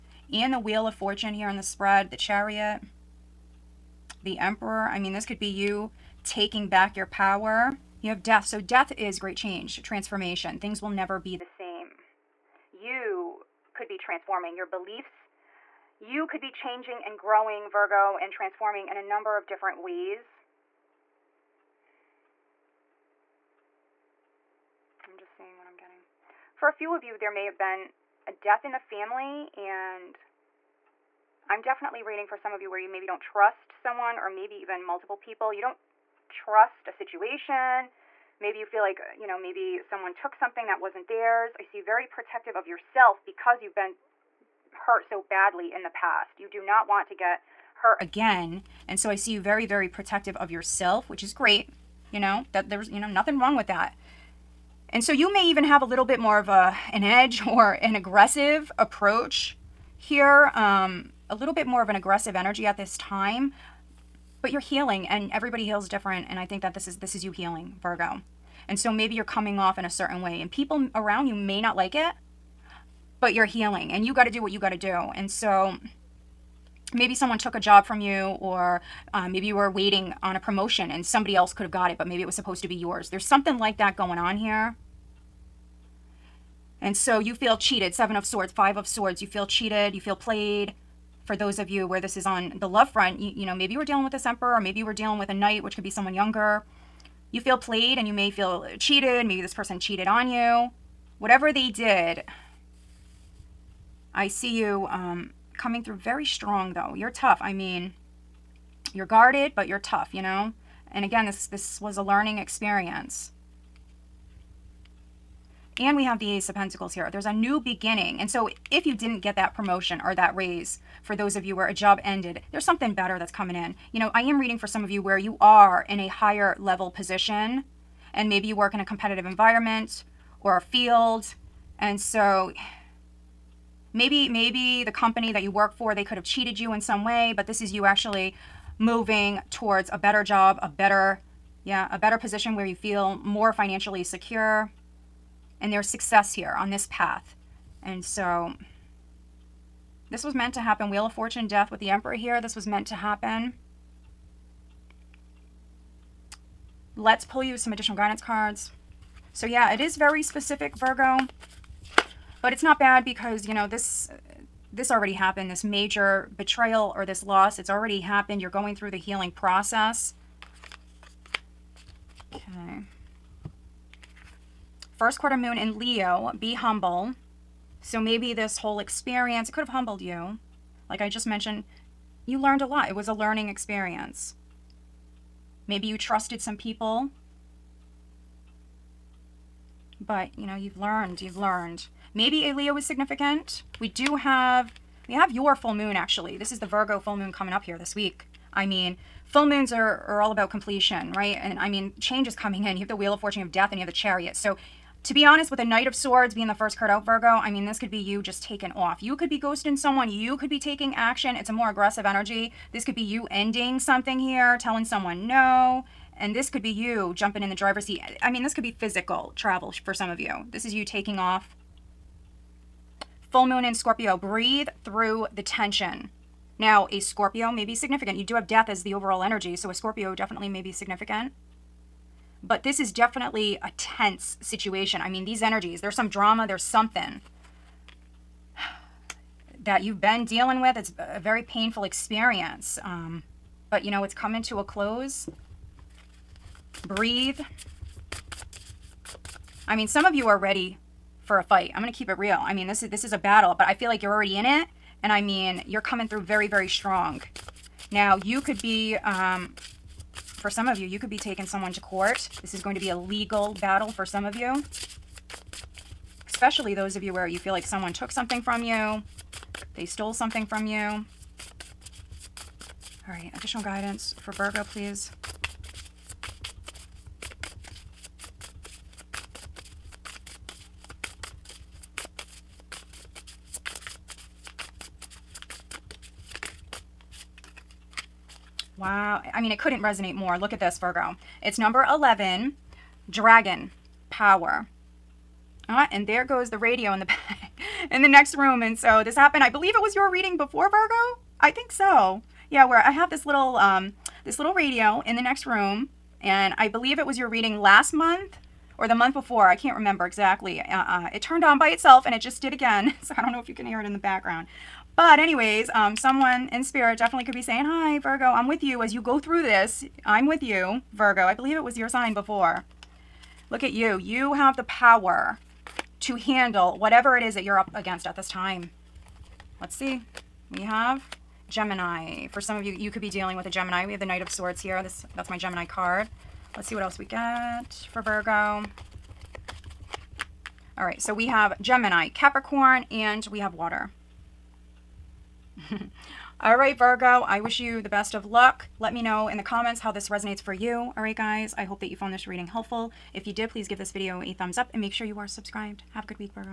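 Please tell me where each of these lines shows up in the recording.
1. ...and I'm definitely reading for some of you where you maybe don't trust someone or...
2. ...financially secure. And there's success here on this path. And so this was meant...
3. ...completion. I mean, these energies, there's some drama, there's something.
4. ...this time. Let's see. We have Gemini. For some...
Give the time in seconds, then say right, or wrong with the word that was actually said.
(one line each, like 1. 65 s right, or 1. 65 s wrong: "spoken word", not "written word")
1. 29 s right
2. 143 s right
3. 234 s wrong: "situation", not "completion"
4. 328 s right.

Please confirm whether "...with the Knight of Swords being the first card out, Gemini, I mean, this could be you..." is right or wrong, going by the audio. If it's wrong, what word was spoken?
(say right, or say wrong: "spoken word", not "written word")
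wrong: "Virgo", not "Gemini".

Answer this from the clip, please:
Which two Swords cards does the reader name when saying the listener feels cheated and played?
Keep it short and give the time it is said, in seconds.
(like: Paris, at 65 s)
Seven of Swords, Five of Swords, at 87 s.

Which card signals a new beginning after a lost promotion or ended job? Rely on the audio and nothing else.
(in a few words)
Ace of Pentacles.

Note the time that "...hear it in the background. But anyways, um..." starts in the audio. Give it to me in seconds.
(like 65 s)
313 s.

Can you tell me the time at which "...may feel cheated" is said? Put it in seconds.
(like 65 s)
98 s.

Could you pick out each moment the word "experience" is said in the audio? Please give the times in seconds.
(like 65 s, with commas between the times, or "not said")
112 s, 178 s, 183 s, 241 s.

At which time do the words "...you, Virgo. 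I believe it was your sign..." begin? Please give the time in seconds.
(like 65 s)
320 s.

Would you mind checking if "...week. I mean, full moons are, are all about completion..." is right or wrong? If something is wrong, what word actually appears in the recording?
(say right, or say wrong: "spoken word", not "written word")
right.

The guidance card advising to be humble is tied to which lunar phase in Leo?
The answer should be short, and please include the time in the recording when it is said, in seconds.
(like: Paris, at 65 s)
First quarter moon, at 175 s.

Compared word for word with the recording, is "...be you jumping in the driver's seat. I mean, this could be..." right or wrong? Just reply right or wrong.
right.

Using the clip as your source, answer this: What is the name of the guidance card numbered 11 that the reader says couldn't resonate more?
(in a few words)
Dragon Power.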